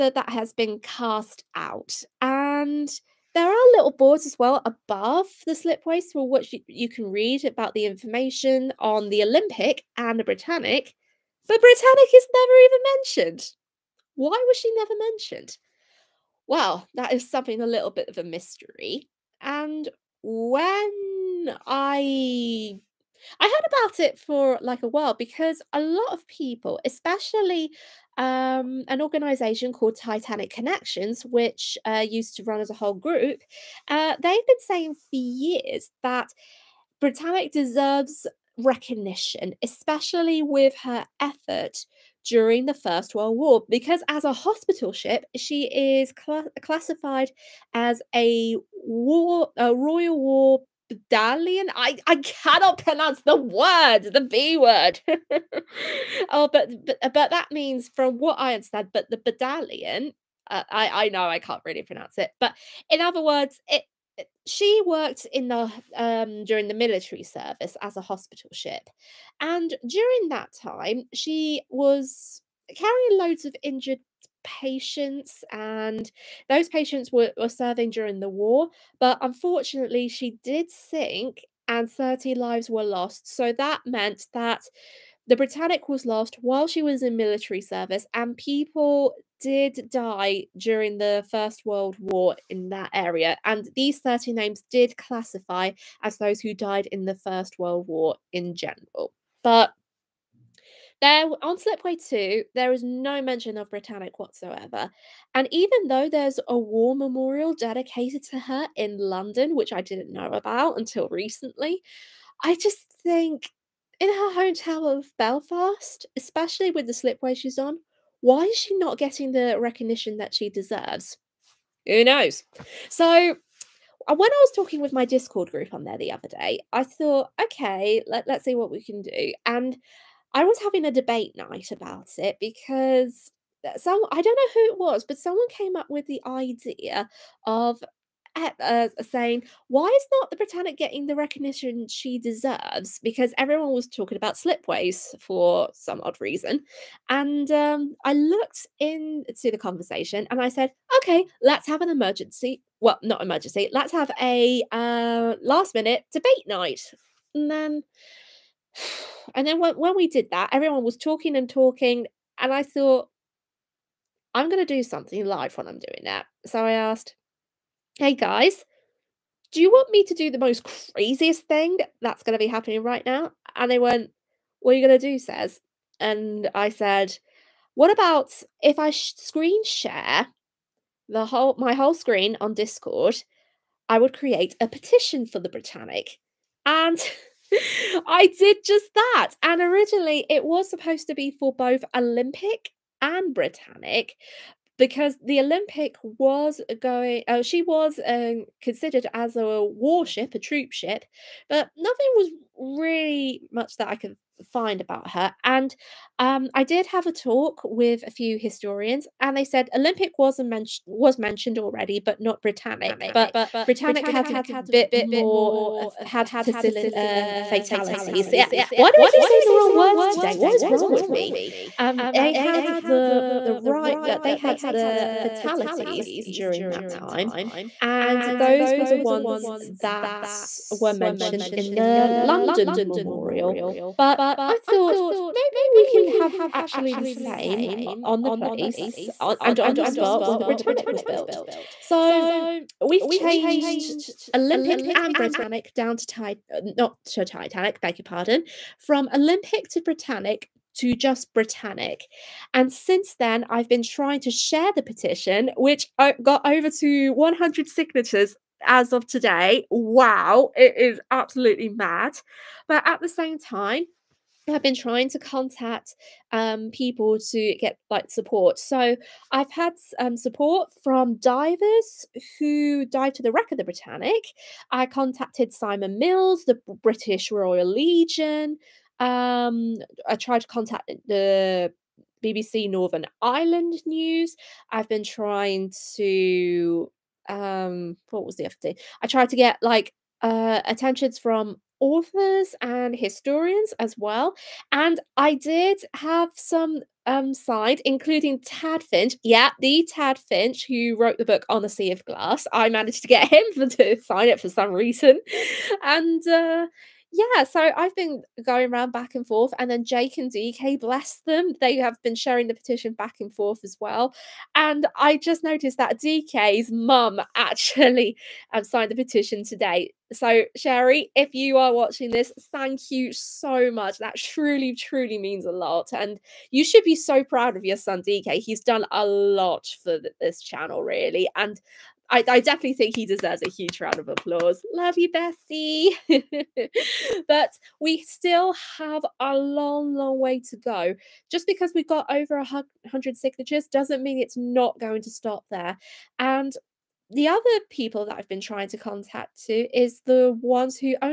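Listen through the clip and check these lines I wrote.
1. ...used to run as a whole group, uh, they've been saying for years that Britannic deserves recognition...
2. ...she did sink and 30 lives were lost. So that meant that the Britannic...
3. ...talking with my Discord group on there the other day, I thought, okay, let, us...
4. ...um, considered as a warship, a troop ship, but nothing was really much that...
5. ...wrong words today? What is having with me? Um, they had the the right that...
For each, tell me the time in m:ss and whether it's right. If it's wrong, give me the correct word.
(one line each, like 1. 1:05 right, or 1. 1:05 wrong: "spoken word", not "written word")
1. 0:32 right
2. 1:20 right
3. 2:04 right
4. 3:18 right
5. 3:39 wrong: "wrong", not "having".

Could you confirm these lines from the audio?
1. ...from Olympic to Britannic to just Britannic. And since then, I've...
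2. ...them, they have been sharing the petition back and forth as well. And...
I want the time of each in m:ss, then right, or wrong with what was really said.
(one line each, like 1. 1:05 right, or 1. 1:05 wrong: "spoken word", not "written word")
1. 4:08 right
2. 5:11 right.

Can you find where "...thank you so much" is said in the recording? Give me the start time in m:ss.
5:22.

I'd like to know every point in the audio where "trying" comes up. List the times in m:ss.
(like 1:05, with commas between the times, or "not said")
4:13, 4:24, 4:45, 5:48.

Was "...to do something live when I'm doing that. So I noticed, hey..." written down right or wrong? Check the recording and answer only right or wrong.
wrong.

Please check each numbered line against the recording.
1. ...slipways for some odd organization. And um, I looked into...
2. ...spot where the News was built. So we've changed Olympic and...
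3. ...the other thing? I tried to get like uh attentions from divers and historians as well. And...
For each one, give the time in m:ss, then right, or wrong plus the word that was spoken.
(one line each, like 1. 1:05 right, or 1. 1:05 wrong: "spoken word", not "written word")
1. 2:24 wrong: "reason", not "organization"
2. 3:59 wrong: "Britannic", not "News"
3. 4:48 wrong: "authors", not "divers".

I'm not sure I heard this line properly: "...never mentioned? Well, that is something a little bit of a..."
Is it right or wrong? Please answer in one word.
right.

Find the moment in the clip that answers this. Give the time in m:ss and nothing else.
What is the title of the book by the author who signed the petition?
5:01.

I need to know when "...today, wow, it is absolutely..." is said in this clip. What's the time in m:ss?
4:19.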